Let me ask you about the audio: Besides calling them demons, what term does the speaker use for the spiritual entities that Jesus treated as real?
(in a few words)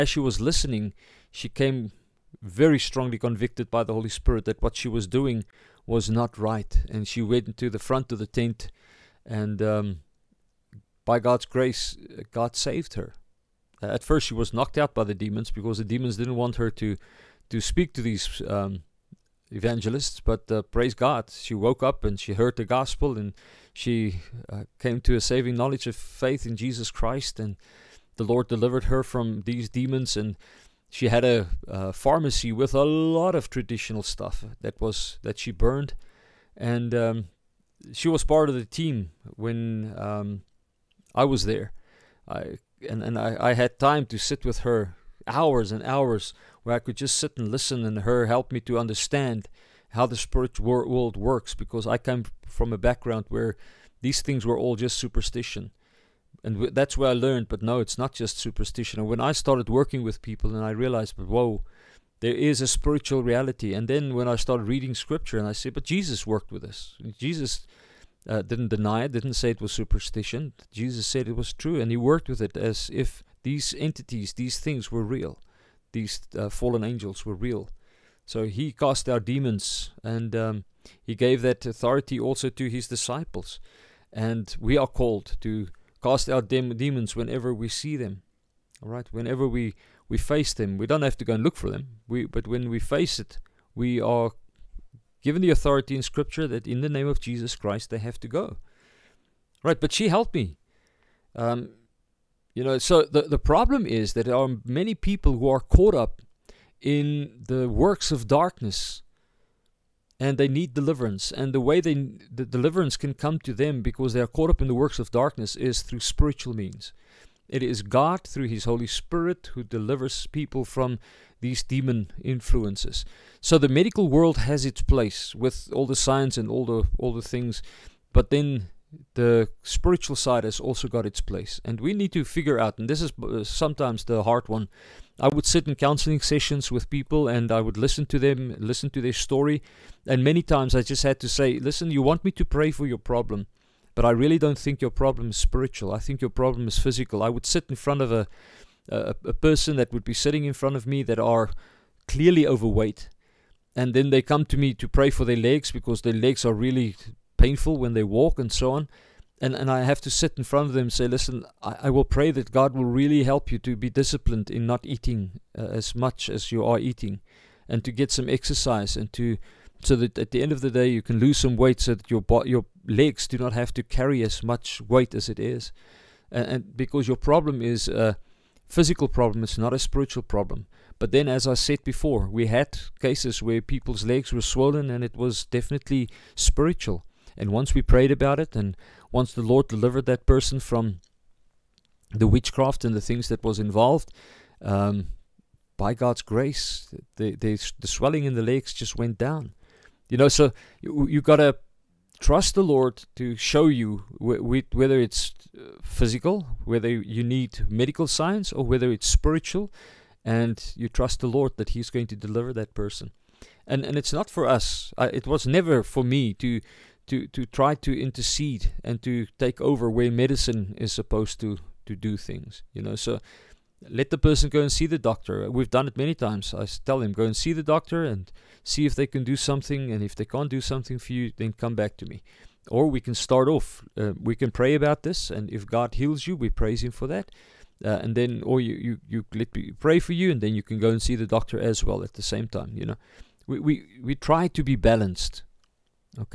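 Fallen angels.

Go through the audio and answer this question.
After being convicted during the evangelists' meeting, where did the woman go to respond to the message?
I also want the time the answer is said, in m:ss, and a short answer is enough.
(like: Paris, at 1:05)
Front of the tent, at 0:07.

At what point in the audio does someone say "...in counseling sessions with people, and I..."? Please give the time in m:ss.
2:15.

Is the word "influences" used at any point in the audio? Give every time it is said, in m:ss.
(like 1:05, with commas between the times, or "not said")
2:02.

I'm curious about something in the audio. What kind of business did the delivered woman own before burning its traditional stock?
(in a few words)
A pharmacy.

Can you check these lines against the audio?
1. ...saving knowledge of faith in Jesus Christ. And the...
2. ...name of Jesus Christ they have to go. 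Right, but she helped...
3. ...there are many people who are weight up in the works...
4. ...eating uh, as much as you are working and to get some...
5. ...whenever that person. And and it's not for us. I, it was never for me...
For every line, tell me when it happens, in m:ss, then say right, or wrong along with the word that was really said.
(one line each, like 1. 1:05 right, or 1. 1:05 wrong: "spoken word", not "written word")
1. 0:25 right
2. 1:36 right
3. 1:44 wrong: "caught", not "weight"
4. 2:44 wrong: "eating", not "working"
5. 3:32 wrong: "deliver", not "whenever".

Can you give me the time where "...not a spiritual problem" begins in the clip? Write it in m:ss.
2:59.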